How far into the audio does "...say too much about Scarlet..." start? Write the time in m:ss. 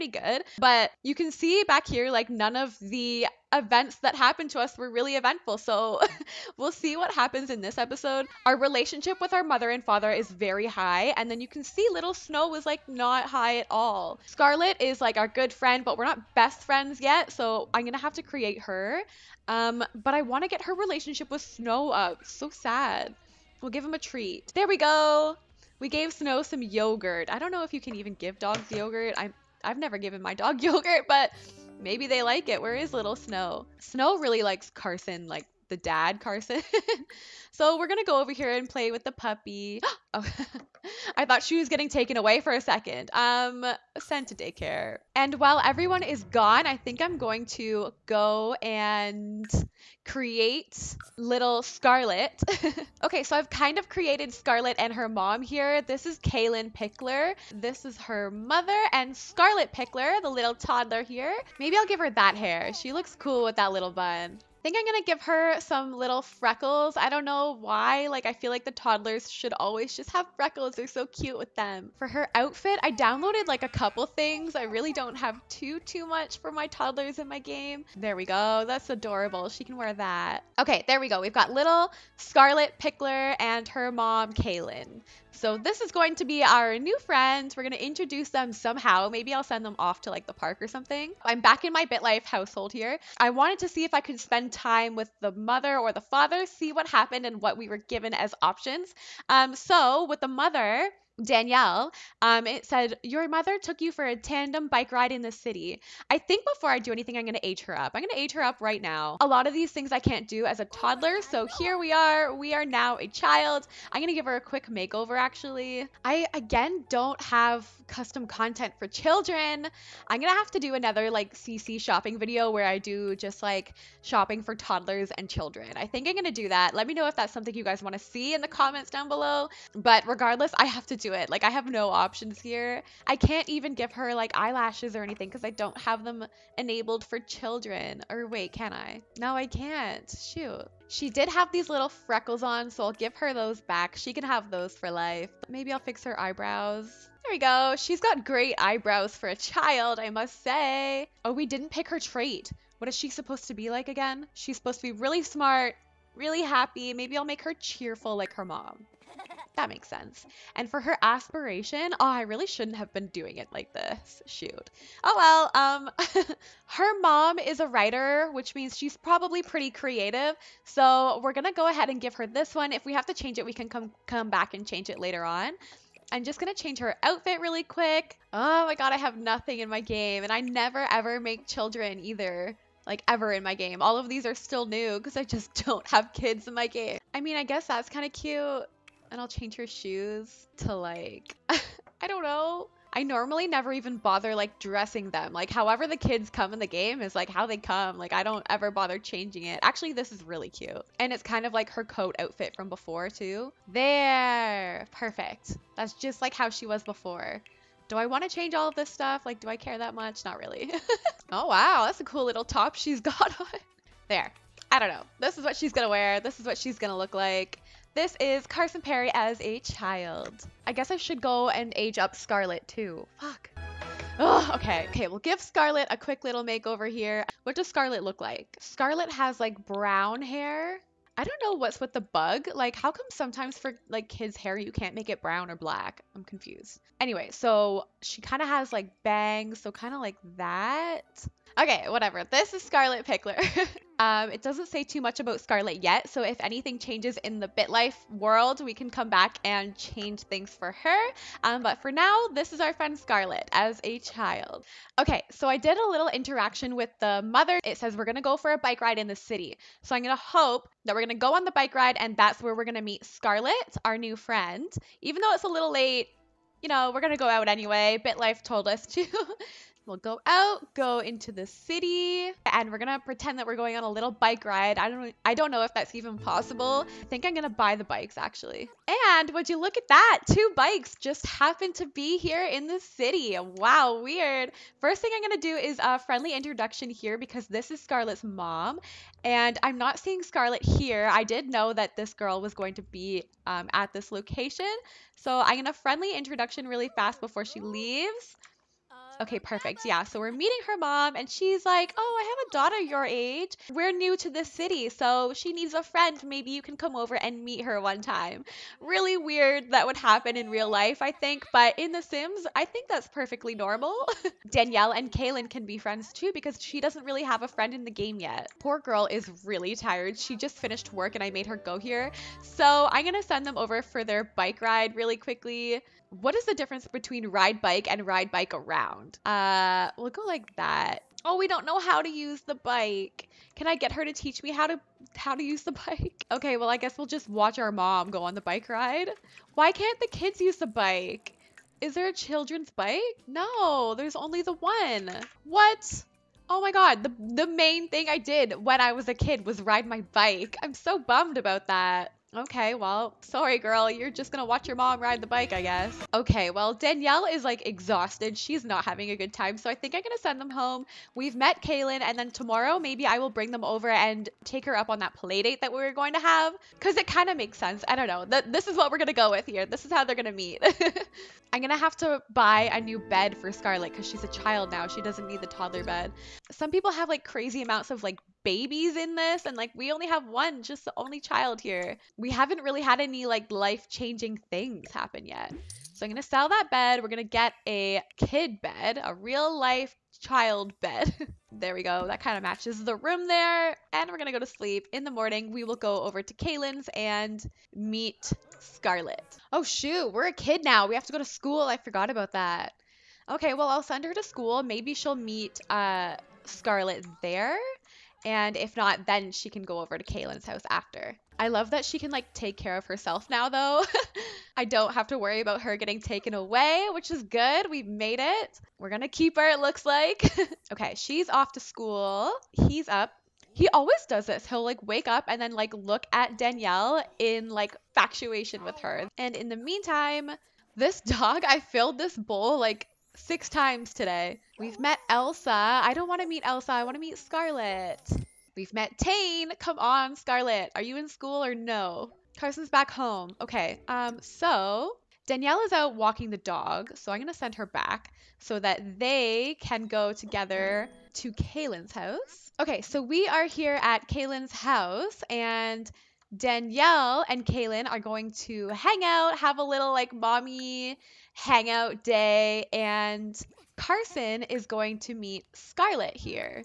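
4:04.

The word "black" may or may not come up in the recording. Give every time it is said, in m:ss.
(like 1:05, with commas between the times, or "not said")
3:55.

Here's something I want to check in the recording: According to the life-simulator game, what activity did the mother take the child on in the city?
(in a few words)
Tandem bike ride.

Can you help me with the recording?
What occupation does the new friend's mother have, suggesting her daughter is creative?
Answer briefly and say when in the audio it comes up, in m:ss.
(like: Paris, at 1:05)
Writer, at 2:46.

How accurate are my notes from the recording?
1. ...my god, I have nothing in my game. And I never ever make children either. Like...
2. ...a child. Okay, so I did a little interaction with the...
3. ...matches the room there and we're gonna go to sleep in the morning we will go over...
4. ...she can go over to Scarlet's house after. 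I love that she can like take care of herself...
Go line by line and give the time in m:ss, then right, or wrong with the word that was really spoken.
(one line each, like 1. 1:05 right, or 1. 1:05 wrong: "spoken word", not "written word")
1. 2:58 right
2. 4:13 right
3. 6:32 right
4. 6:49 wrong: "Kaylin", not "Scarlet".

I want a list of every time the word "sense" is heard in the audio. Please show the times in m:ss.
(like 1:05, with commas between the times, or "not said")
2:39, 6:07.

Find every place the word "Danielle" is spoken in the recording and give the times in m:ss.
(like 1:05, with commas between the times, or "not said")
1:41, 5:14, 5:56, 7:06, 7:25, 7:36.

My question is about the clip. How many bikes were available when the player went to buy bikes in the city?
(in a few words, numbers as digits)
2.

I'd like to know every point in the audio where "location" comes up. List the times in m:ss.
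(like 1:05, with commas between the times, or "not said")
4:54.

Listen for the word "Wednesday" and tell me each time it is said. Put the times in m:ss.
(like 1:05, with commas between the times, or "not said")
not said.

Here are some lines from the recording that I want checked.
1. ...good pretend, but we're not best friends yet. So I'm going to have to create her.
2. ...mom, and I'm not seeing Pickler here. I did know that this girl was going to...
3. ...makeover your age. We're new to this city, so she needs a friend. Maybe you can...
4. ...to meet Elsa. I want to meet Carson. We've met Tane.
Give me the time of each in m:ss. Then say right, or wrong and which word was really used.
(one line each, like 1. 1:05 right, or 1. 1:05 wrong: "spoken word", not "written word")
1. 0:15 wrong: "friend", not "pretend"
2. 4:48 wrong: "Scarlett", not "Pickler"
3. 5:02 wrong: "daughter", not "makeover"
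4. 7:16 wrong: "Scarlett", not "Carson".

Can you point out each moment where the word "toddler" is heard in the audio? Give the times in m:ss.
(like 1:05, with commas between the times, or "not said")
1:00, 1:08, 1:16, 1:50, 2:04, 6:15.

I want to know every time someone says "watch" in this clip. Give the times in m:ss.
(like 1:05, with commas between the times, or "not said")
5:37, 5:54.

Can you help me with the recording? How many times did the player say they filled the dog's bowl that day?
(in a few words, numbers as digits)
6.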